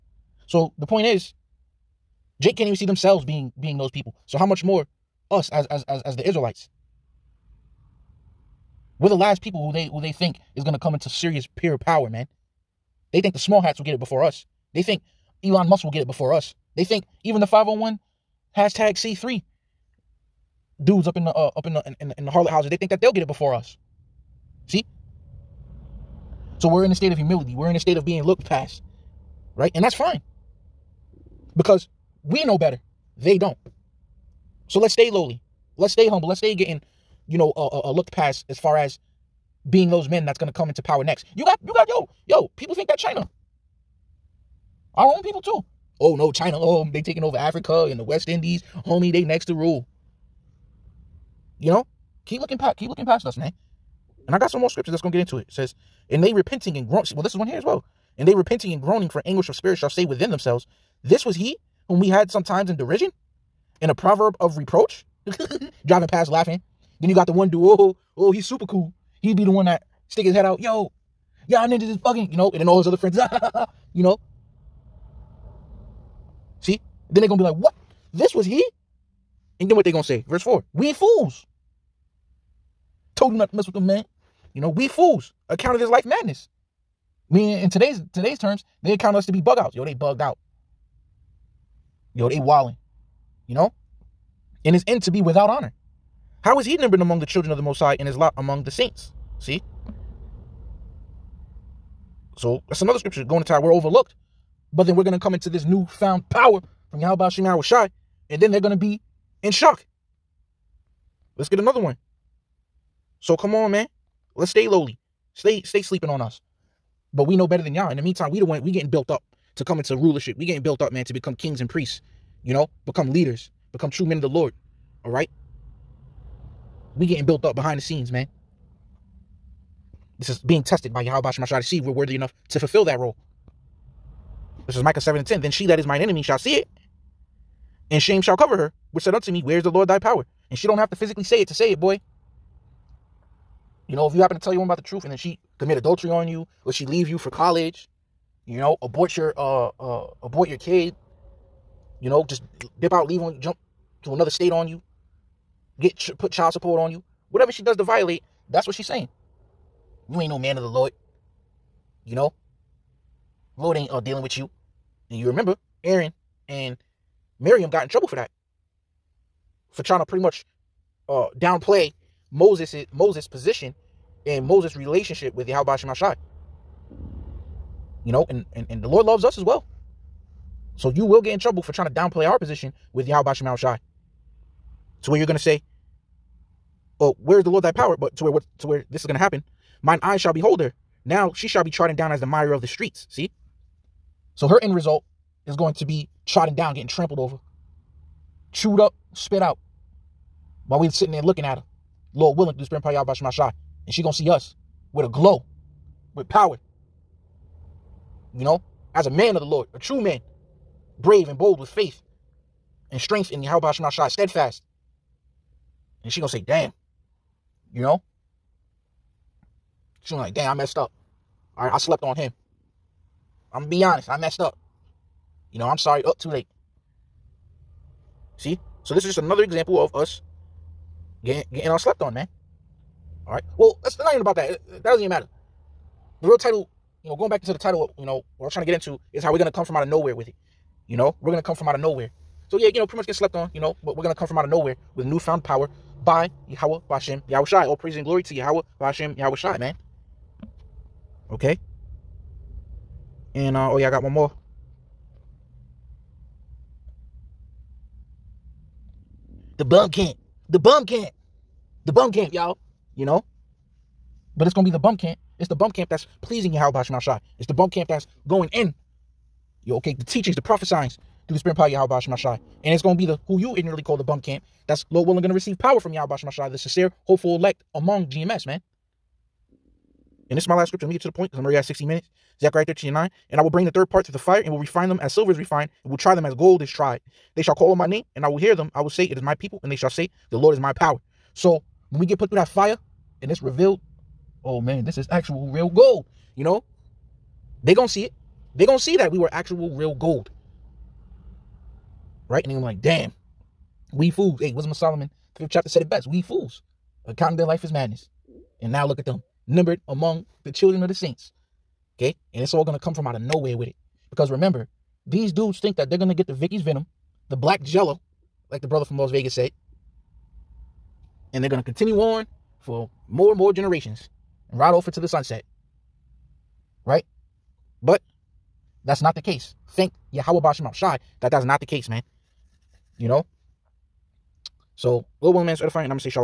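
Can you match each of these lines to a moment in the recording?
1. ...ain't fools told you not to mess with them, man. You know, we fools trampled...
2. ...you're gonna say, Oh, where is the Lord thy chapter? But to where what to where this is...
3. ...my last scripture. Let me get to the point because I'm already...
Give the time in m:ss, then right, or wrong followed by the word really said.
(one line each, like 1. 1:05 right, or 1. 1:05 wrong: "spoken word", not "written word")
1. 1:20 wrong: "accounted", not "trampled"
2. 3:05 wrong: "power", not "chapter"
3. 4:40 right.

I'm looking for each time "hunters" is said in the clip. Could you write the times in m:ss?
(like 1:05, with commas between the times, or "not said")
not said.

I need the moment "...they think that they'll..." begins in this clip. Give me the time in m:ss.
0:22.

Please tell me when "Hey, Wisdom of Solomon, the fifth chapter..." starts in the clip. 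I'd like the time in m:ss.
5:04.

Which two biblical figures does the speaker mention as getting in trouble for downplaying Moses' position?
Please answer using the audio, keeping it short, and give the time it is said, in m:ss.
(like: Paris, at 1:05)
Aaron and Miriam, at 2:45.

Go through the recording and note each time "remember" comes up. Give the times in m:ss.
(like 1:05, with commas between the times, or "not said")
2:45, 5:14.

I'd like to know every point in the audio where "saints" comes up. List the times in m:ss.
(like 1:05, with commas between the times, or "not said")
1:38, 5:10.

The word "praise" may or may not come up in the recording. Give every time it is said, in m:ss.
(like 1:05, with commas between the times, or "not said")
4:07.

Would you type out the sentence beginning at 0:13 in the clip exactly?
They think the small hats will get it before us.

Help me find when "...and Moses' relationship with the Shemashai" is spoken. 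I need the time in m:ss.
2:54.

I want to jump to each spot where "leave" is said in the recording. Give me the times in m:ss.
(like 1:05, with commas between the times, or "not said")
2:26, 2:33.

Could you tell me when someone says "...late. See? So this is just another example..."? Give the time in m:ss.
3:46.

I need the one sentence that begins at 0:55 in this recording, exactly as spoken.
it says, and they repenting and groaning.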